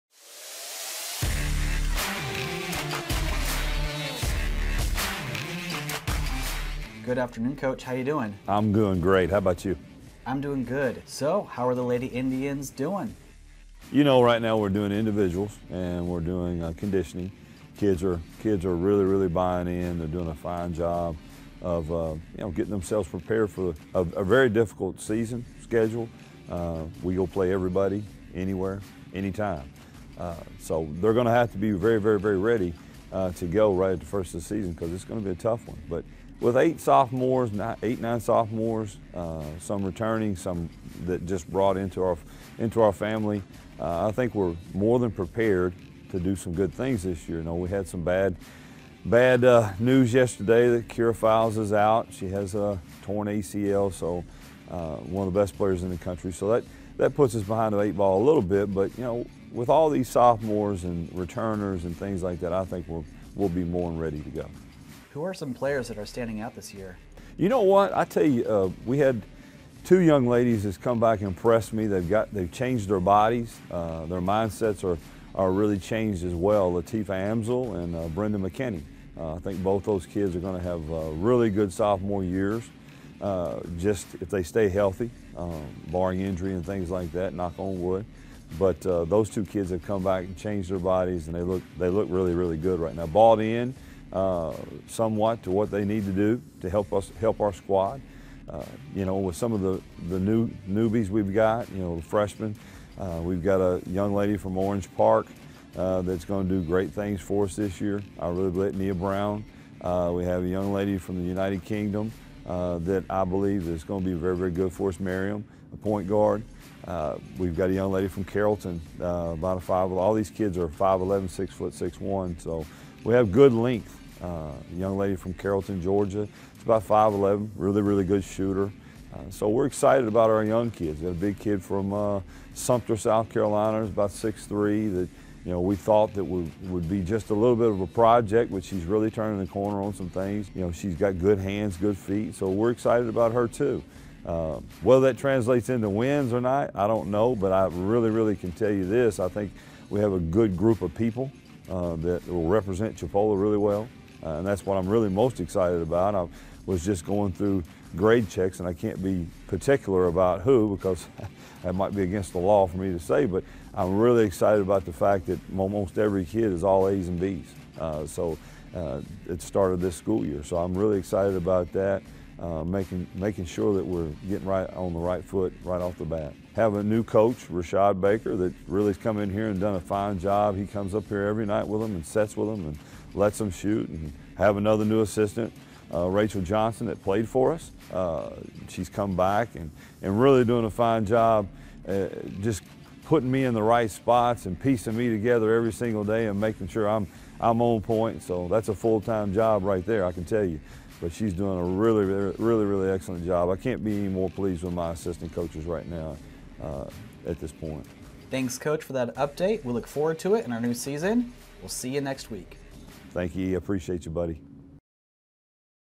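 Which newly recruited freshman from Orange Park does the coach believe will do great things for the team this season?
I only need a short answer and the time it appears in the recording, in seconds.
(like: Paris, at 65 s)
Nia Brown, at 108 s.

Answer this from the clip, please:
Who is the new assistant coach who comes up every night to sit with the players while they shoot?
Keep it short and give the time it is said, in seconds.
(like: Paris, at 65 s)
Rashad Baker, at 177 s.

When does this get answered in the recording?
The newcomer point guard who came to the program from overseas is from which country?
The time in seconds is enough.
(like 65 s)
111 s.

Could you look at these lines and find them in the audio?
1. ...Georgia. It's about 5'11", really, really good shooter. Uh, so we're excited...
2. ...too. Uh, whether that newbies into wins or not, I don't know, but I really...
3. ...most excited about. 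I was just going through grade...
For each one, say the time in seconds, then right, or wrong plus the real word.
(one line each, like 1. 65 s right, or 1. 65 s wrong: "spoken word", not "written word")
1. 125 s right
2. 143 s wrong: "translates", not "newbies"
3. 155 s right.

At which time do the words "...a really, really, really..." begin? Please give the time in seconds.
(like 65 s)
201 s.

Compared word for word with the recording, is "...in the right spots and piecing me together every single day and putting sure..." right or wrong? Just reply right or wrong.
wrong.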